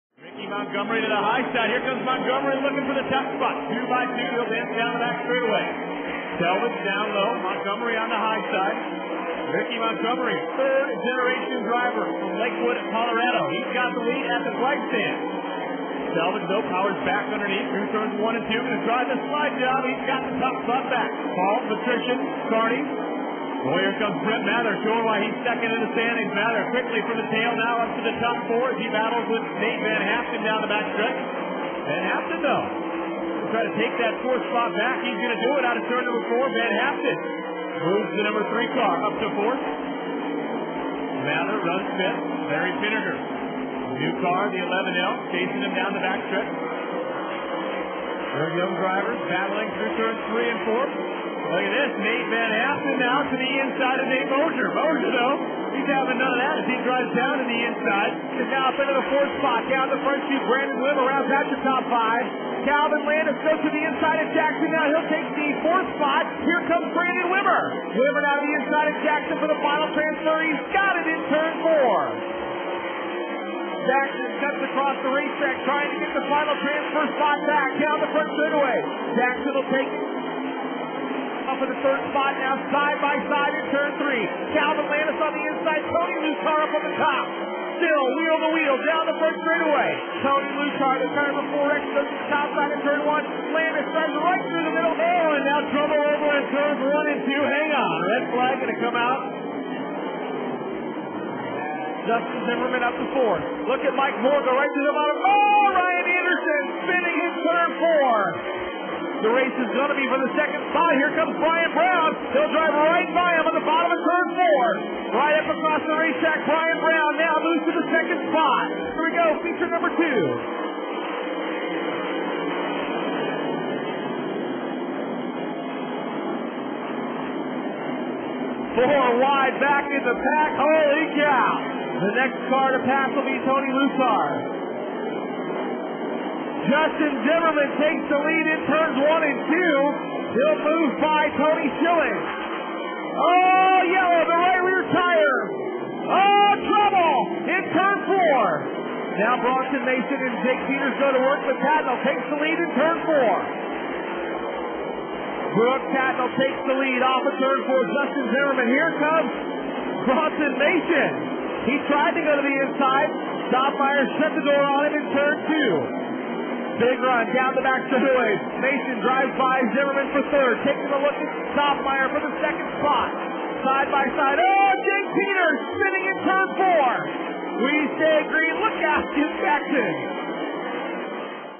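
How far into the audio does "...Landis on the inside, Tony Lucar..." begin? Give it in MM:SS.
01:24.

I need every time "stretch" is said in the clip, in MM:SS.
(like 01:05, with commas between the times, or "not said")
00:30, 00:46.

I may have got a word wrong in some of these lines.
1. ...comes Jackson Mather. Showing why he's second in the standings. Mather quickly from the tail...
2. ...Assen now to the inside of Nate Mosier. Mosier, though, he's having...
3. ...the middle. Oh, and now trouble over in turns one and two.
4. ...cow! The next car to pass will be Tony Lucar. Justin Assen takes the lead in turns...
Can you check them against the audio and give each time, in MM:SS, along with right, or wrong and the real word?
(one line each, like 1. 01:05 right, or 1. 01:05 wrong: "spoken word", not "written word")
1. 00:24 wrong: "Brett", not "Jackson"
2. 00:52 right
3. 01:34 right
4. 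02:11 wrong: "Zimmerman", not "Assen".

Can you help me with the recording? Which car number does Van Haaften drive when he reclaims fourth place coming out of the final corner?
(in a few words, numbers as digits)
3.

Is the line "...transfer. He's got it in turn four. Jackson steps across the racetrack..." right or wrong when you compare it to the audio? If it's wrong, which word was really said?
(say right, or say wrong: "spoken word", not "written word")
right.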